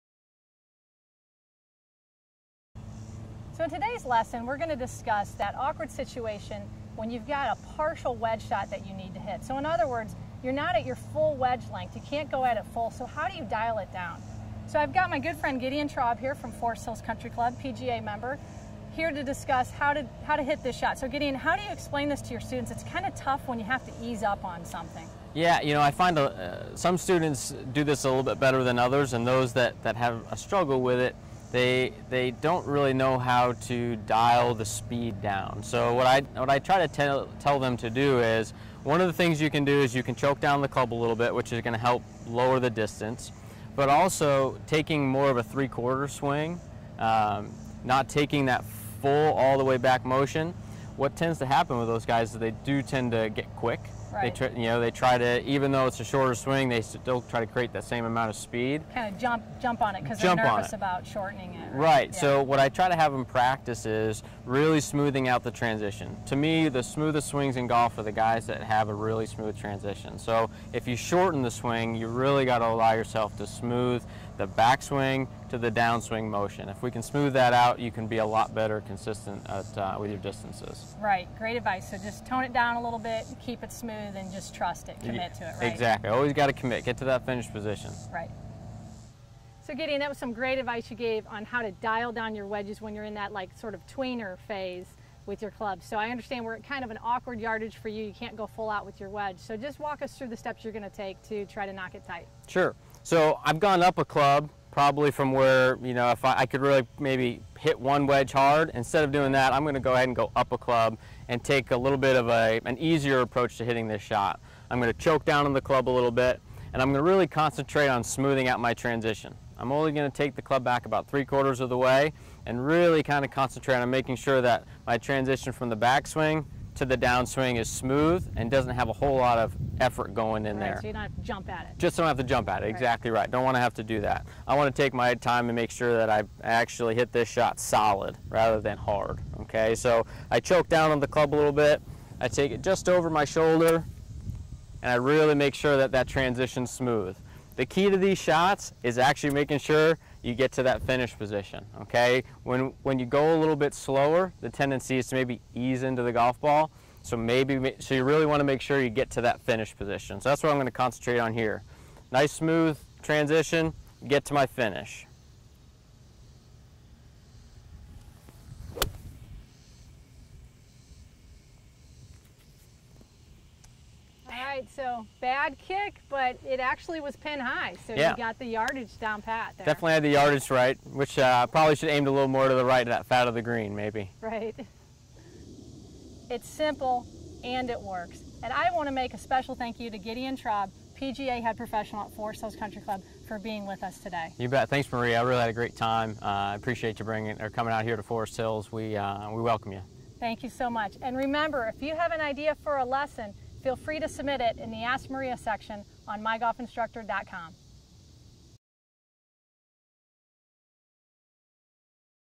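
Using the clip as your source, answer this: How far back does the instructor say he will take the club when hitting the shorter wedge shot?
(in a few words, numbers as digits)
three quarters.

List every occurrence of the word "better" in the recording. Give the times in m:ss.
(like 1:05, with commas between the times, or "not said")
0:28, 1:18.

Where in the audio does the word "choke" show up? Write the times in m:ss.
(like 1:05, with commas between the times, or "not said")
0:40, 1:54, 2:20.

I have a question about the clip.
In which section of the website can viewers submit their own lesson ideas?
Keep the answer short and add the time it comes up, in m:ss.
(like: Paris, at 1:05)
Ask Maria, at 3:24.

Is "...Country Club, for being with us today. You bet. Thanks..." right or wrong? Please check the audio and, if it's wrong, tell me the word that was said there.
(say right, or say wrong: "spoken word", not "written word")
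right.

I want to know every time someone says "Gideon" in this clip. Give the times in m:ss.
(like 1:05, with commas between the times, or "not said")
0:15, 0:21, 1:29, 3:09.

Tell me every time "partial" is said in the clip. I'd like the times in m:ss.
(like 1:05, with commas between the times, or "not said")
0:07.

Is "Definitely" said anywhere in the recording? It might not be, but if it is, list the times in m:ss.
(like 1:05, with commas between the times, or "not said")
2:59.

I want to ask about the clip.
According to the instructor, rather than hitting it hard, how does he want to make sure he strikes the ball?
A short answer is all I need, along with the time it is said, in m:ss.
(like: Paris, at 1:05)
solid, at 2:17.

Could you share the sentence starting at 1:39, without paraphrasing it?
So just walk us through the steps you're going to take to try to knock it tight.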